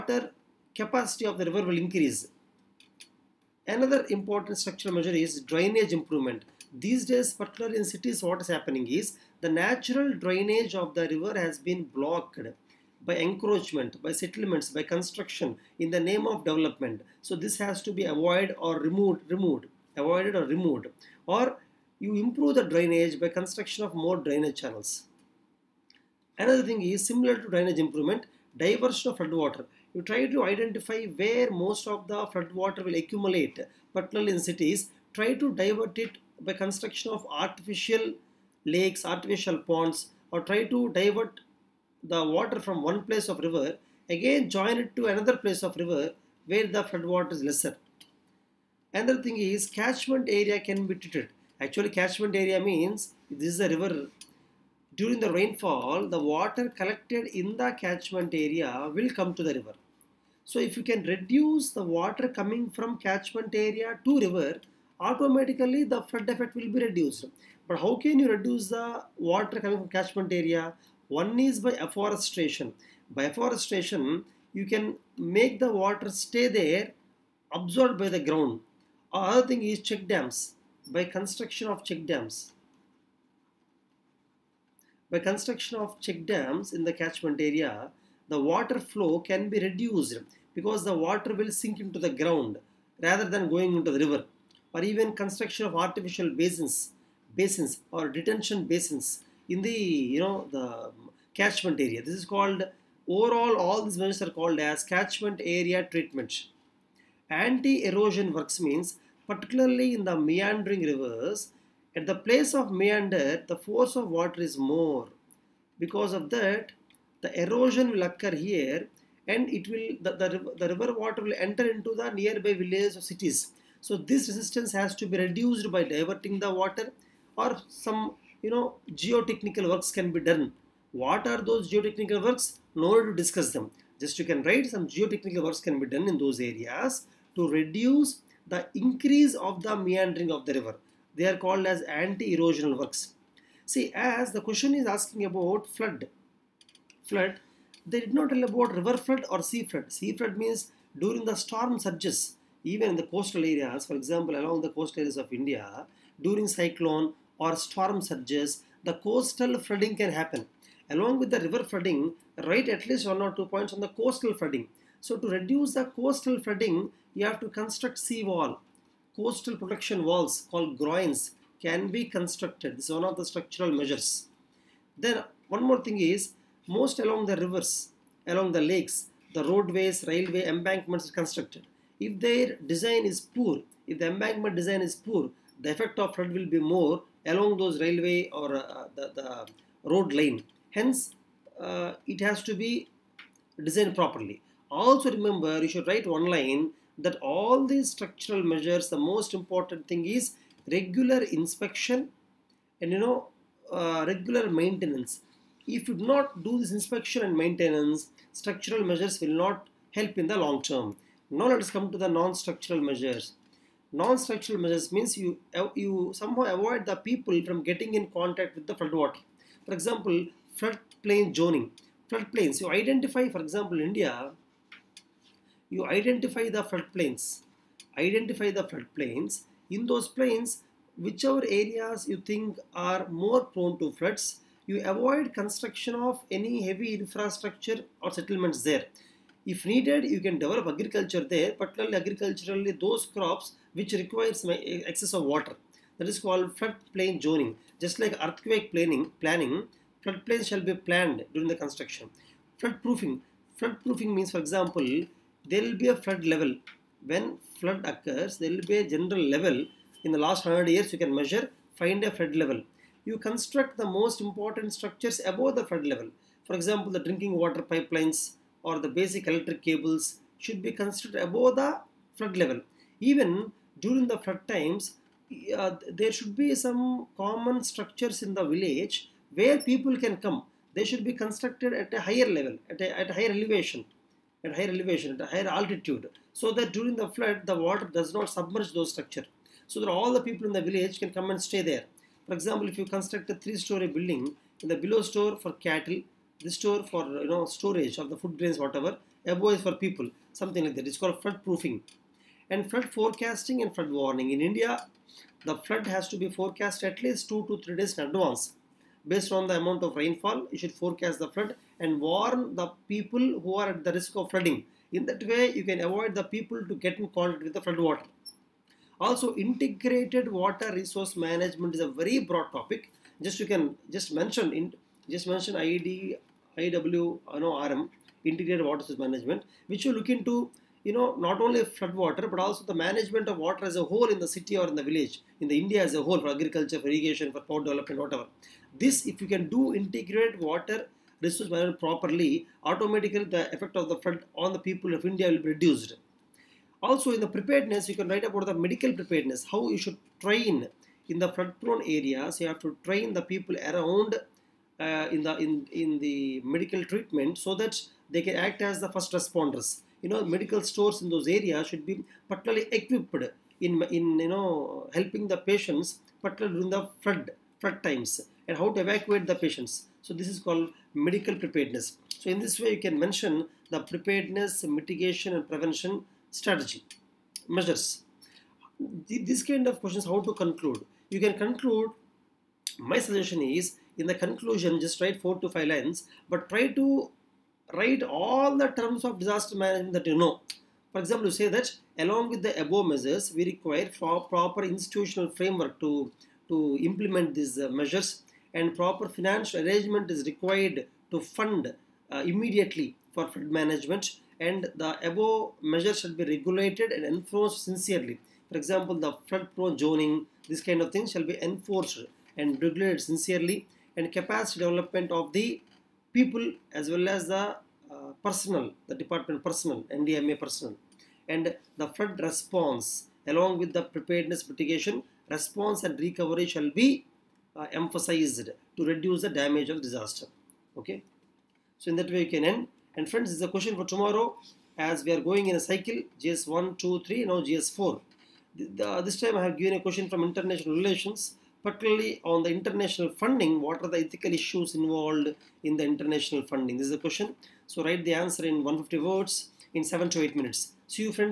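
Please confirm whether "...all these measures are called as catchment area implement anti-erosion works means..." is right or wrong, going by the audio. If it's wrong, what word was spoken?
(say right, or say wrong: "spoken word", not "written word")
wrong: "treatment", not "implement".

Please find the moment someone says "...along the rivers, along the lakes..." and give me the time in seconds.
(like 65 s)
176 s.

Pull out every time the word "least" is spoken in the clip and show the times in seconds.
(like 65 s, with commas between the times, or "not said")
162 s, 307 s.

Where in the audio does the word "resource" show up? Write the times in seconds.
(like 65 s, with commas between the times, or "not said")
320 s, 328 s, 341 s.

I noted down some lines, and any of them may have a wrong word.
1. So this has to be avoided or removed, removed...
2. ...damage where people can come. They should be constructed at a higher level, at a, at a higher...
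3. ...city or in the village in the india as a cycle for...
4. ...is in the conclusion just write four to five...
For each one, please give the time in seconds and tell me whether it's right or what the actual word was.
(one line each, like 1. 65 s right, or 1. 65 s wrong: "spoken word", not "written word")
1. 17 s right
2. 278 s wrong: "village", not "damage"
3. 334 s wrong: "whole", not "cycle"
4. 383 s right.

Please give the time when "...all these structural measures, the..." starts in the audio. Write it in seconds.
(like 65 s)
197 s.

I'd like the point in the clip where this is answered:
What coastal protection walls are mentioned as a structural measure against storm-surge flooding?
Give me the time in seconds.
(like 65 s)
170 s.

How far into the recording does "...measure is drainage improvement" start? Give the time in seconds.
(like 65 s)
4 s.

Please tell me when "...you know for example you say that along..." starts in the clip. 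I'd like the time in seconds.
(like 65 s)
390 s.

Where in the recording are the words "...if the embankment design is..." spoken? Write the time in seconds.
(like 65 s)
183 s.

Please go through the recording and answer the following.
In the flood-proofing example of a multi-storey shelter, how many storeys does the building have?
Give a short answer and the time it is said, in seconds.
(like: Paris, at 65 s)
3, at 293 s.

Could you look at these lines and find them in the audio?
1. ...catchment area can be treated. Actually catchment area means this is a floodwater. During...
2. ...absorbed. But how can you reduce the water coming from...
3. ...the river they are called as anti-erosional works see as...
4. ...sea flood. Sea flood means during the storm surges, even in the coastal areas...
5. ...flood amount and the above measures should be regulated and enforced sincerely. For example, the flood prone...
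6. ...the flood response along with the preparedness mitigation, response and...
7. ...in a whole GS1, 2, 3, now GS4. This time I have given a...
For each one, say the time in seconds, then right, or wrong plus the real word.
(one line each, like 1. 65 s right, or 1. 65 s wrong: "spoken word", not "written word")
1. 49 s wrong: "river", not "floodwater"
2. 66 s wrong: "reduced", not "absorbed"
3. 140 s right
4. 149 s right
5. 403 s wrong: "management", not "amount"
6. 421 s right
7. 435 s wrong: "cycle", not "whole".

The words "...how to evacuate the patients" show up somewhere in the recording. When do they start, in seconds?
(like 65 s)
368 s.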